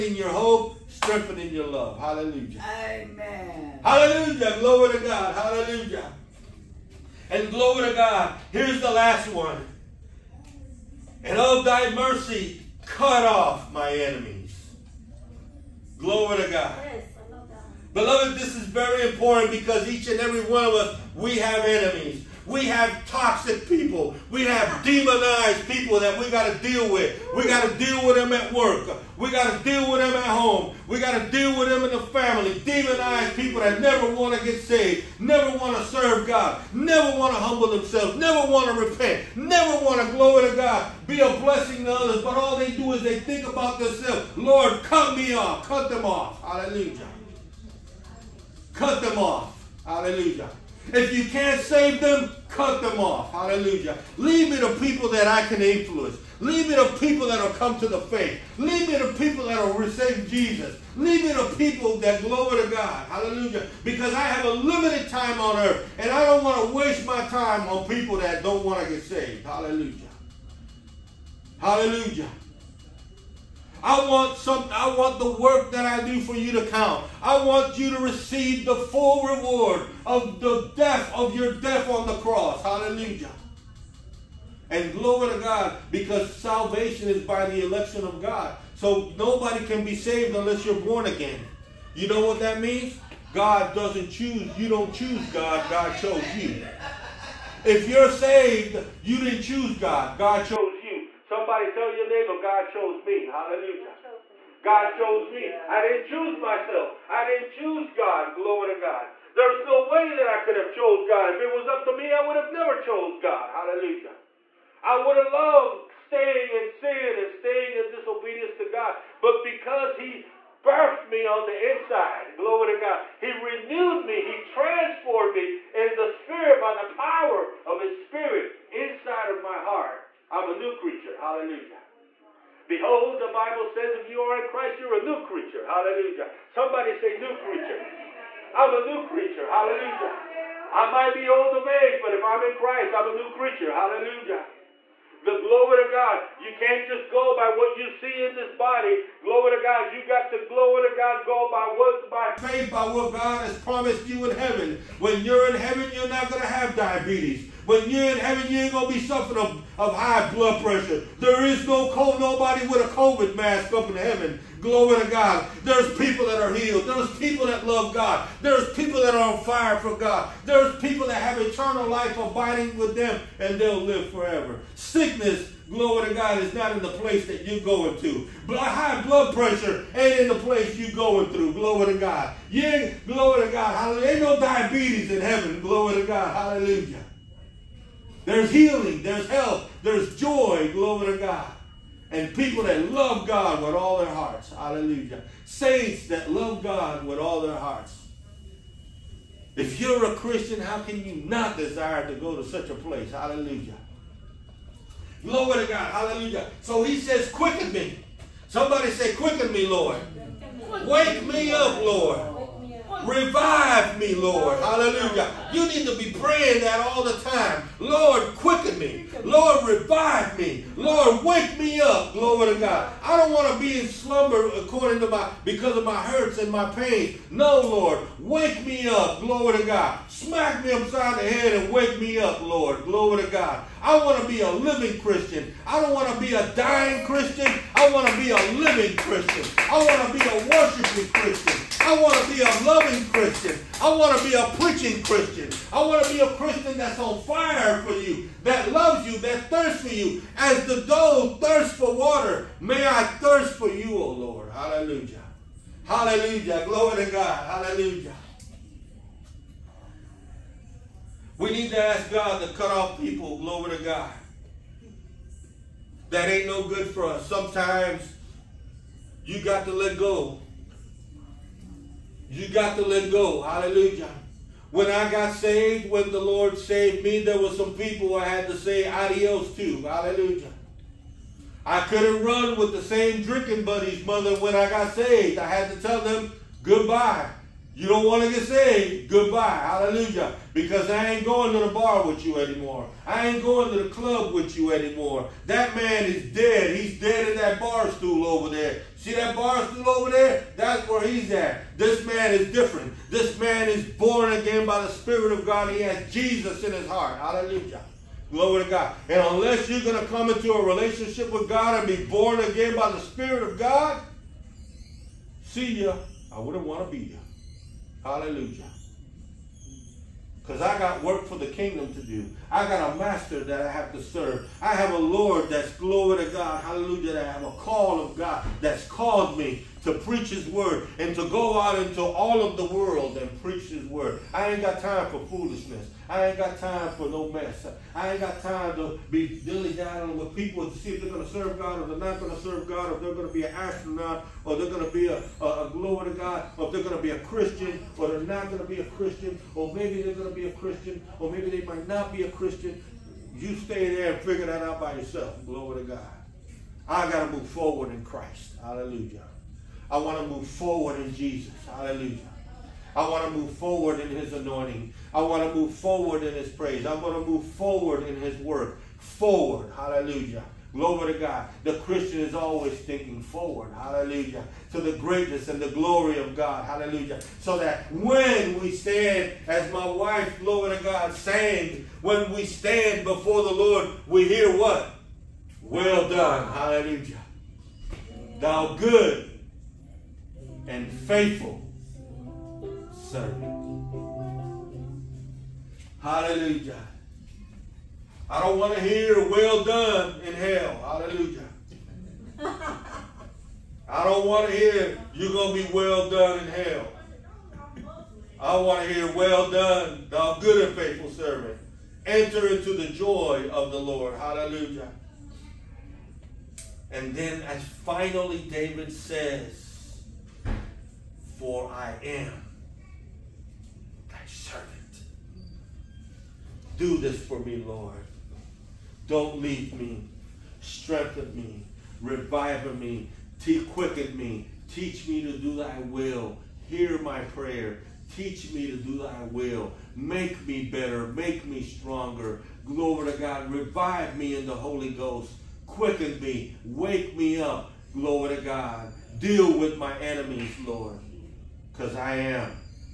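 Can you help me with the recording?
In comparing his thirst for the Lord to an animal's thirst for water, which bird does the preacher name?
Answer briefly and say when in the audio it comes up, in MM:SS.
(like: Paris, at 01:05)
dove, at 04:10.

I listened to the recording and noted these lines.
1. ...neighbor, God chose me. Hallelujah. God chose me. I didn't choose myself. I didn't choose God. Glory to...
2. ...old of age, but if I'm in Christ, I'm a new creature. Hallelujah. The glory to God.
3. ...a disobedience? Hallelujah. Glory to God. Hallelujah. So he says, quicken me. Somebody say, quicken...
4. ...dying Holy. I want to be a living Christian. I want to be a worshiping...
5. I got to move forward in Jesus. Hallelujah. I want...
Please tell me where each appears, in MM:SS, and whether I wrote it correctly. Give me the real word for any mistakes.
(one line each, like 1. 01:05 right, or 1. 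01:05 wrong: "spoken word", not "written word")
1. 01:42 right
2. 02:21 right
3. 03:22 wrong: "place", not "disobedience"
4. 03:56 wrong: "Christian", not "Holy"
5. 05:56 wrong: "Christ", not "Jesus".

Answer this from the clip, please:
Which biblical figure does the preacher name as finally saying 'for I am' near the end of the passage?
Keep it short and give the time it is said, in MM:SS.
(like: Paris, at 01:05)
David, at 06:58.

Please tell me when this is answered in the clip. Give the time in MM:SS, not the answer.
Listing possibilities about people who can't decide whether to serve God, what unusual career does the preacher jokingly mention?
05:43.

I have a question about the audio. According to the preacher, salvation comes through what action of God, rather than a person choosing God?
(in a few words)
election of God.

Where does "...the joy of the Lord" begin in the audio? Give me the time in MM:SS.
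06:52.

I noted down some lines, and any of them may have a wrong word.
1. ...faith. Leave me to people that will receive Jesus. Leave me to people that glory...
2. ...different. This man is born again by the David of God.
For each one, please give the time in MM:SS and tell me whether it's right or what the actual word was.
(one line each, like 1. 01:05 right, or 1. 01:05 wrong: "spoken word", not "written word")
1. 00:58 right
2. 05:02 wrong: "Spirit", not "David".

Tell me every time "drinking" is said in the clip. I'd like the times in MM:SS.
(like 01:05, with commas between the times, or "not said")
04:43.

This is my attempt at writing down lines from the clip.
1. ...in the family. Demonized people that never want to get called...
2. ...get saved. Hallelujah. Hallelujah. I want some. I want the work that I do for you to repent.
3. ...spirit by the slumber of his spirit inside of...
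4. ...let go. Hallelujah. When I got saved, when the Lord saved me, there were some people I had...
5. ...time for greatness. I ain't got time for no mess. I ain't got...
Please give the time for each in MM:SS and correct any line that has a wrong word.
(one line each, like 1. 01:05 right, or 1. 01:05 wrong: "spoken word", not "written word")
1. 00:31 wrong: "saved", not "called"
2. 01:08 wrong: "count", not "repent"
3. 02:06 wrong: "power", not "slumber"
4. 04:32 right
5. 05:34 wrong: "foolishness", not "greatness".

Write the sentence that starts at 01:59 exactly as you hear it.
But because he birthed me on the inside.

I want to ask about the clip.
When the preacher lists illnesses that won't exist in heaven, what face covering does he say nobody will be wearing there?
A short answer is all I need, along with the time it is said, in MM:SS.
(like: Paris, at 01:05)
COVID mask, at 02:42.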